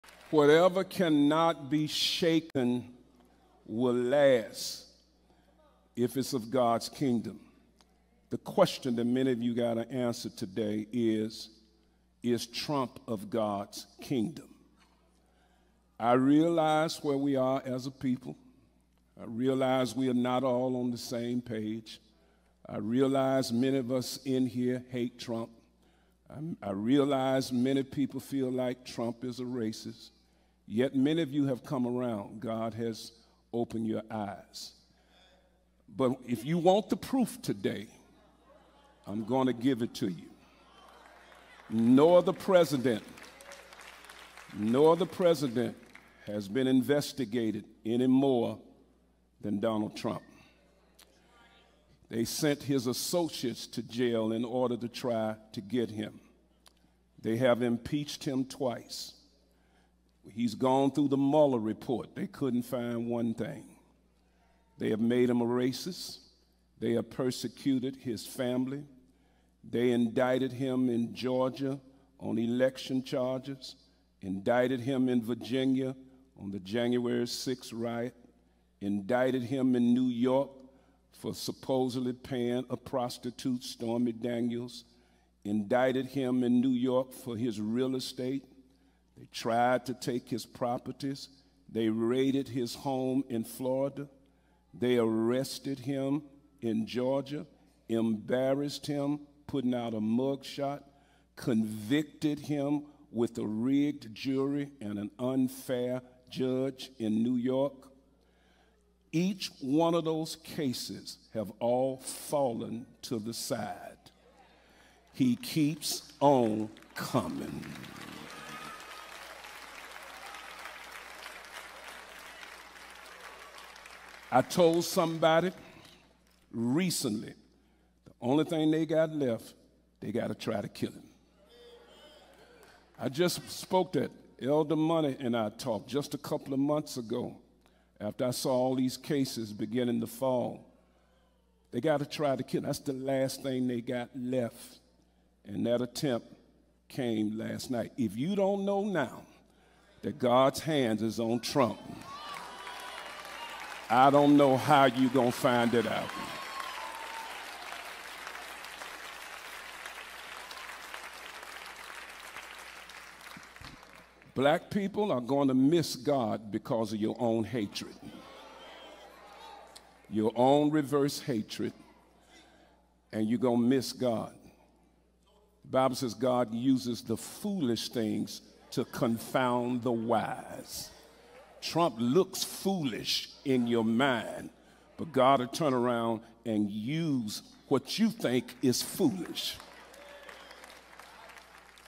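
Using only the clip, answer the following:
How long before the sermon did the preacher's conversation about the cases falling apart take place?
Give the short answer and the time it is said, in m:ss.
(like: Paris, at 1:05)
a couple of months ago, at 2:16.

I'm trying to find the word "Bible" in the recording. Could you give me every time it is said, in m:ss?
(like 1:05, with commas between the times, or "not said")
2:55.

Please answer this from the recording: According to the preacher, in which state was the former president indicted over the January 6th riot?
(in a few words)
Virginia.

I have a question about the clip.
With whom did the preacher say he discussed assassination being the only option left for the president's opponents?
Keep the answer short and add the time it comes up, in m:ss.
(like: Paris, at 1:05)
Elder Money, at 2:14.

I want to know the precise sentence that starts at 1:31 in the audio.
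They raided his home in Florida.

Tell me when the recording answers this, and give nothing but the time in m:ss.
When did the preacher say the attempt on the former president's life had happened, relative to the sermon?
2:27.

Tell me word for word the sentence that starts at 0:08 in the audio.
The question that many of you got to answer today is Is Trump of God's kingdom?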